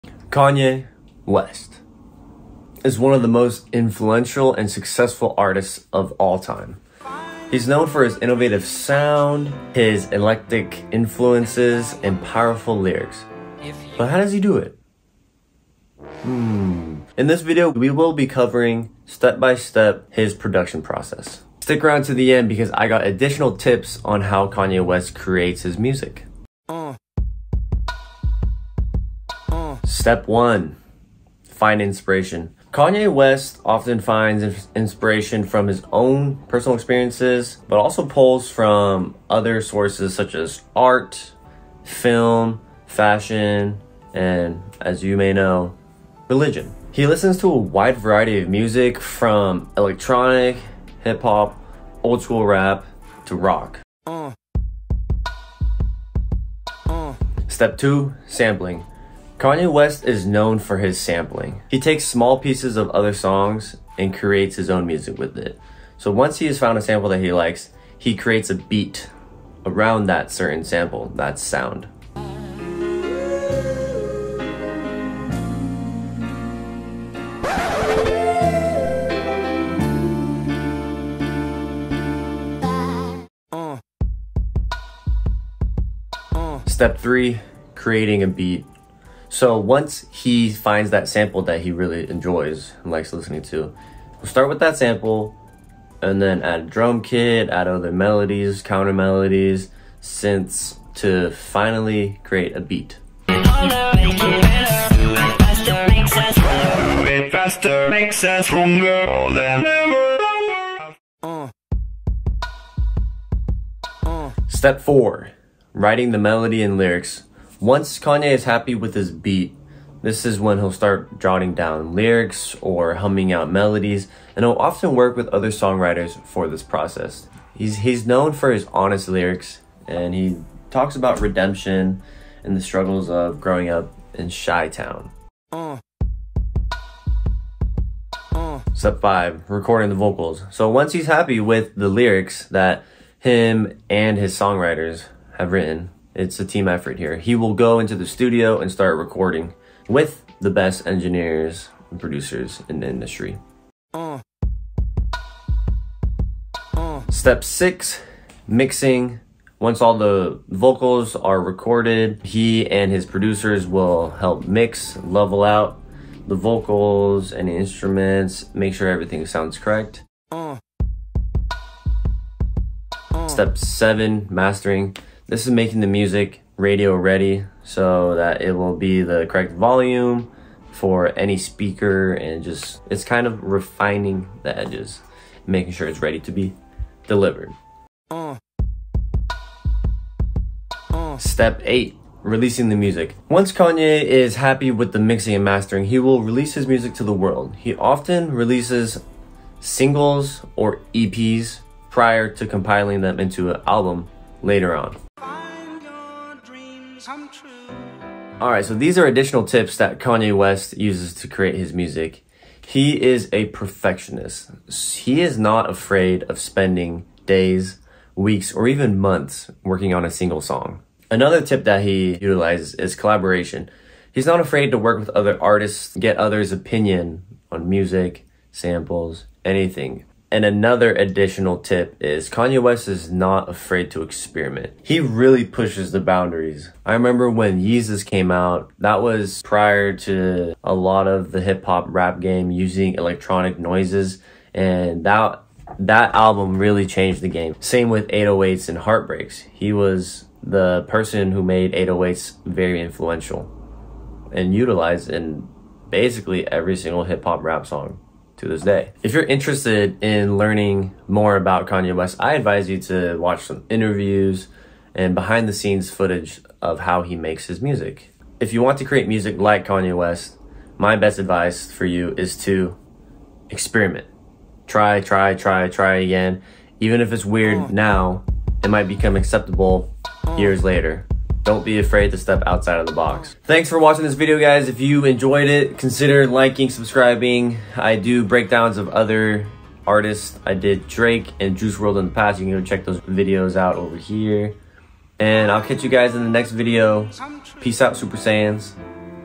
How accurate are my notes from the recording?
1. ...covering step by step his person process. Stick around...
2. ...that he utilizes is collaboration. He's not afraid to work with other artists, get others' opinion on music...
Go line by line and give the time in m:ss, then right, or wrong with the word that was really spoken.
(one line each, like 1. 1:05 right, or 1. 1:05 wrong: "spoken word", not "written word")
1. 0:18 wrong: "production", not "person"
2. 3:41 right.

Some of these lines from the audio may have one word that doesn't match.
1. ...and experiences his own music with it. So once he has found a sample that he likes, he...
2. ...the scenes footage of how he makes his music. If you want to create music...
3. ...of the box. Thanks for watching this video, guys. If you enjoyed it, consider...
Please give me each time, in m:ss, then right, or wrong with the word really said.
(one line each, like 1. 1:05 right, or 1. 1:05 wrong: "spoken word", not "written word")
1. 1:03 wrong: "creates", not "experiences"
2. 4:25 right
3. 4:42 right.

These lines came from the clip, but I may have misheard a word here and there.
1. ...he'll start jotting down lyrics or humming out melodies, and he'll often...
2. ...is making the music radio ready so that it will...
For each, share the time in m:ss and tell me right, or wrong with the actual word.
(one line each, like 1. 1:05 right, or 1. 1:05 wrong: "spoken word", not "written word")
1. 2:00 right
2. 2:55 right.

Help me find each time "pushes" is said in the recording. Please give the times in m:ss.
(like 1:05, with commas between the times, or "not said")
3:55.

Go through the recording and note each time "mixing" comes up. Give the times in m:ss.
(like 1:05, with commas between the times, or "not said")
2:38, 3:14.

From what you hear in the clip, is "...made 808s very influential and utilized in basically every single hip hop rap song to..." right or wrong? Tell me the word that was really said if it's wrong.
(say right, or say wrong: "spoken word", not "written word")
right.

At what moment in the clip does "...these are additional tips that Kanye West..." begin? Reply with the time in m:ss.
3:28.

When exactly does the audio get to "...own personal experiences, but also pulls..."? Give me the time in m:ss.
0:35.